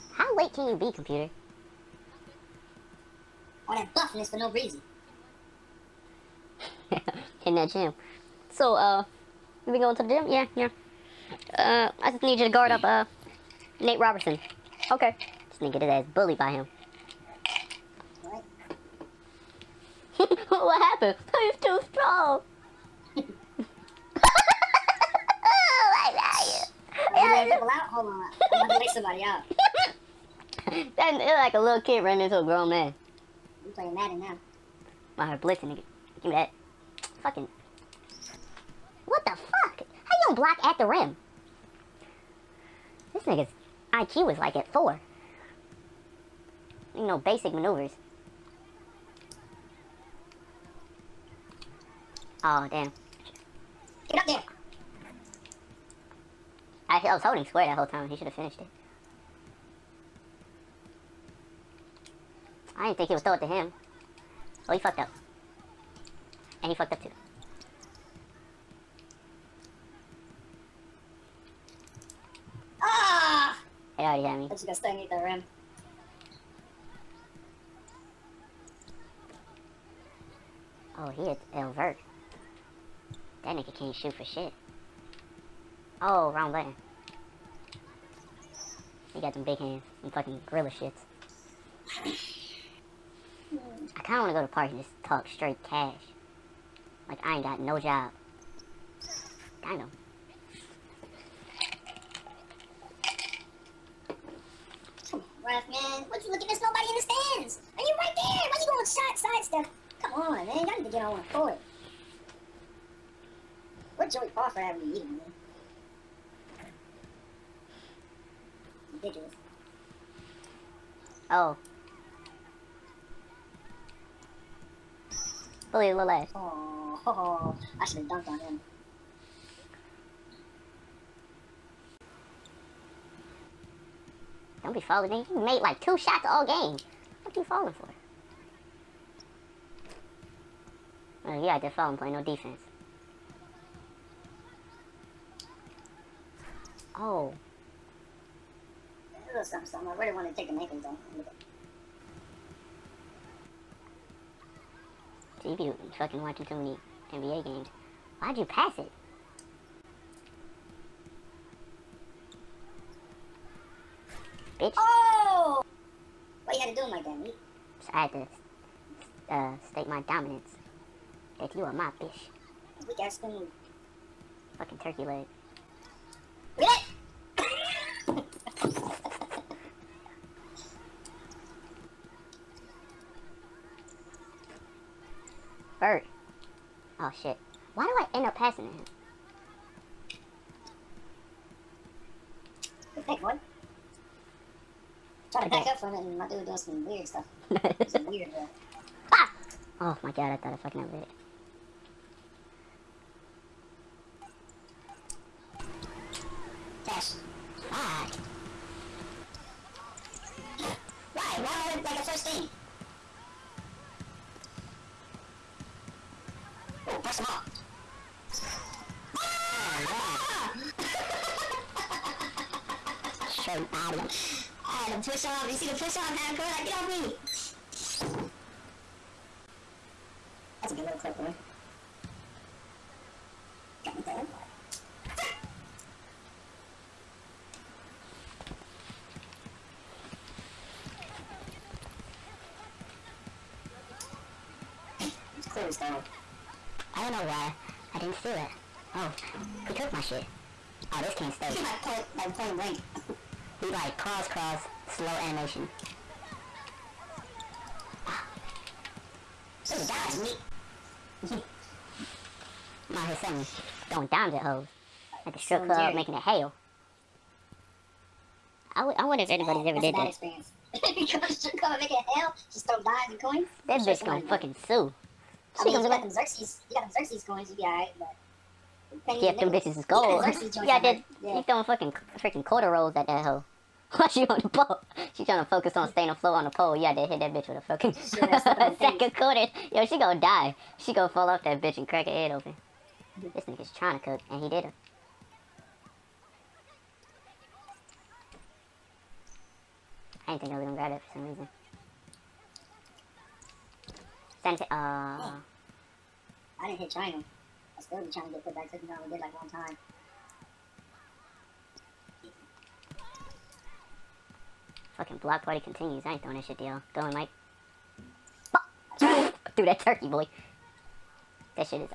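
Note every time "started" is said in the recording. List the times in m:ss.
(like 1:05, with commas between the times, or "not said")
not said.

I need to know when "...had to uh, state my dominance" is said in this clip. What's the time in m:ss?
2:48.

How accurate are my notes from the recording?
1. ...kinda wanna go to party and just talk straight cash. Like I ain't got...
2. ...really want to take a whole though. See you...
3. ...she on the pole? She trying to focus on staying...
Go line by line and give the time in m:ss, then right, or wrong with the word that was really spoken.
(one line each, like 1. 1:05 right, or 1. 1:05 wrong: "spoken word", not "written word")
1. 1:34 right
2. 2:29 wrong: "maple", not "whole"
3. 4:44 right.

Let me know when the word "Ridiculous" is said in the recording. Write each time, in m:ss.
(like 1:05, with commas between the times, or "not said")
1:58.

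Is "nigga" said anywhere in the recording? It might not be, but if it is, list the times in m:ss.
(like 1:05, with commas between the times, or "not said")
0:35, 0:43, 1:23, 4:53.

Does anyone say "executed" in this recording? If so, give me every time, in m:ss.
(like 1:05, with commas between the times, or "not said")
not said.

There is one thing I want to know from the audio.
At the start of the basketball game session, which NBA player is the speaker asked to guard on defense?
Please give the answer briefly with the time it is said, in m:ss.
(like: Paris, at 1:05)
Nate Robinson, at 0:13.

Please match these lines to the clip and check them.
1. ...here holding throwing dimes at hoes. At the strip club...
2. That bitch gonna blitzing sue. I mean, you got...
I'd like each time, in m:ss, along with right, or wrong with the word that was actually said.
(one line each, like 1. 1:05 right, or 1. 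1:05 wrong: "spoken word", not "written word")
1. 4:23 wrong: "selling", not "holding"
2. 4:33 wrong: "fucking", not "blitzing".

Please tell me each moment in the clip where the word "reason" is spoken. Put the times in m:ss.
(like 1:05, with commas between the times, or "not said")
0:04, 5:01.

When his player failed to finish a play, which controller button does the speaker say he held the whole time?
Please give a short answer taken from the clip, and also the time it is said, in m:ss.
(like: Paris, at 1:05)
Square, at 0:57.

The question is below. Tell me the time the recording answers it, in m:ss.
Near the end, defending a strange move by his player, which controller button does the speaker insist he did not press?
5:06.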